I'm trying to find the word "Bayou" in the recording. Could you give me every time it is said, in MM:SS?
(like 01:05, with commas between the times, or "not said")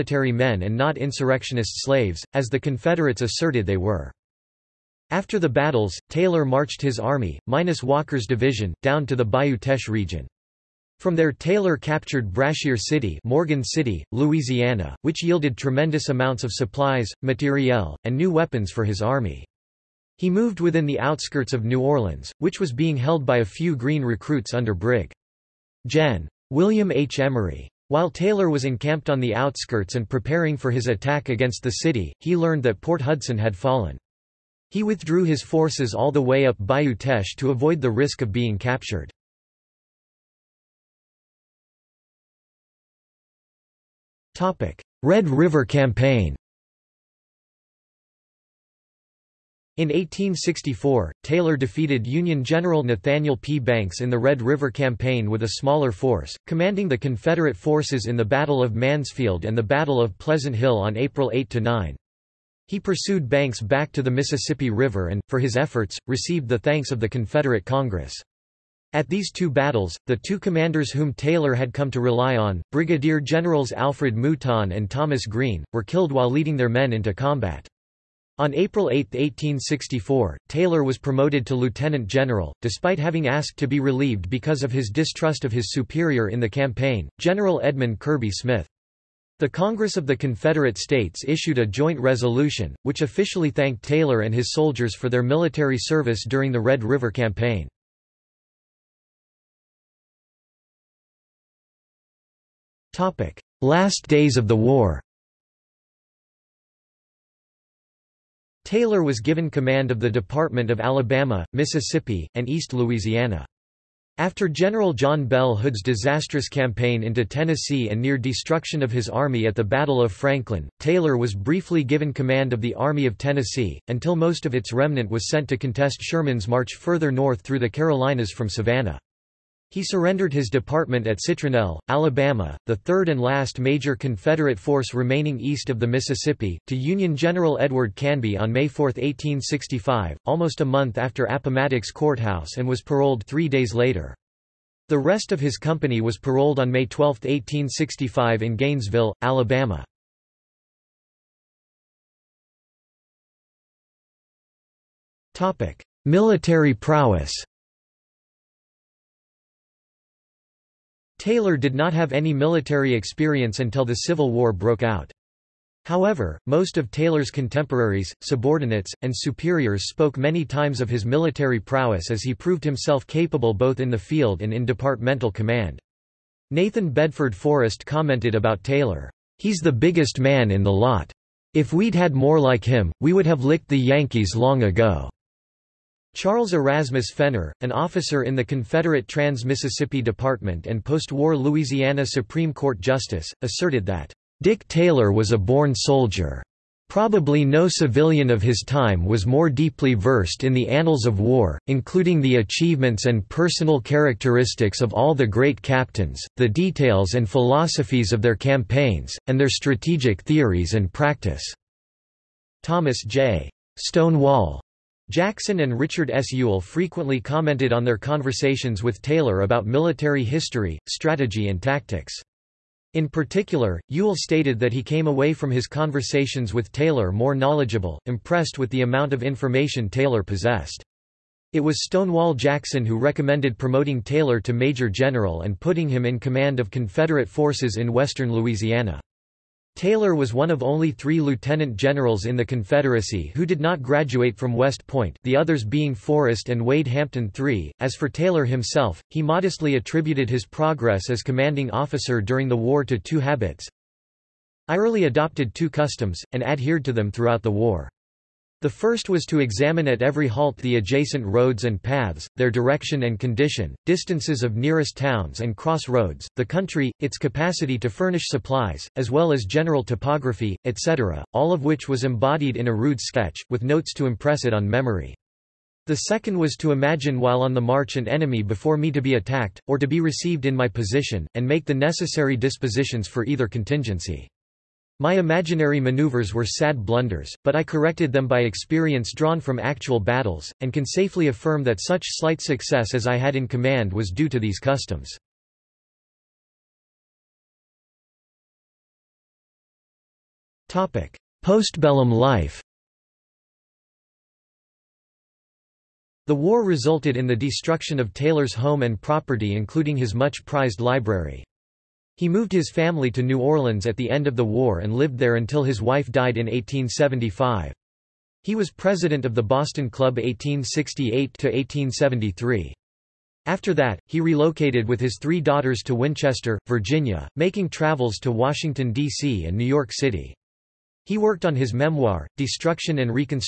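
00:09, 00:36.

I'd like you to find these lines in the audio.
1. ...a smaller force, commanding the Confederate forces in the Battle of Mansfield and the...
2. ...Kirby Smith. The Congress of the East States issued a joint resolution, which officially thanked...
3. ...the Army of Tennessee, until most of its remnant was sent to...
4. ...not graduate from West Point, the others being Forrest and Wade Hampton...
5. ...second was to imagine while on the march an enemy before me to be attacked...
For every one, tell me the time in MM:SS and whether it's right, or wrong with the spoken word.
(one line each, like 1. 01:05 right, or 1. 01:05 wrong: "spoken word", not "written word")
1. 00:55 right
2. 01:27 wrong: "Confederate", not "East"
3. 02:02 right
4. 04:03 right
5. 04:36 right.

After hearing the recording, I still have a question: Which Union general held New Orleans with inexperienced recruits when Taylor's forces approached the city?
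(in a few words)
William H. Emery.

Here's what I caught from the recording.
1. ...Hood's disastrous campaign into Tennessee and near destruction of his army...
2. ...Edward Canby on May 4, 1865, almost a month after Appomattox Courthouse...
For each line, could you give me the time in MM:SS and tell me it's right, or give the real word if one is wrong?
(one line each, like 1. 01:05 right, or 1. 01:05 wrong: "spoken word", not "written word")
1. 01:55 right
2. 02:17 right.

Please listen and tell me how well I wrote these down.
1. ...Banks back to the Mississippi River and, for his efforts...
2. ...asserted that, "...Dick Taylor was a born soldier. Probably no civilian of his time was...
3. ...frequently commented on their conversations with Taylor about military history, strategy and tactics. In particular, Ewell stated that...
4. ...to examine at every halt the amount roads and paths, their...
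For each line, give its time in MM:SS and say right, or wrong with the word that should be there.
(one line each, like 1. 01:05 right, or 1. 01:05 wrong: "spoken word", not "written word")
1. 01:03 right
2. 03:13 right
3. 03:36 right
4. 04:19 wrong: "adjacent", not "amount".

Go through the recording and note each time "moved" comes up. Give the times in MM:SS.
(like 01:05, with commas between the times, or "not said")
00:20, 05:12.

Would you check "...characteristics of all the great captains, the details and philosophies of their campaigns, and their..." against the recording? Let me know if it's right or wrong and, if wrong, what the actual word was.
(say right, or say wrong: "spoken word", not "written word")
right.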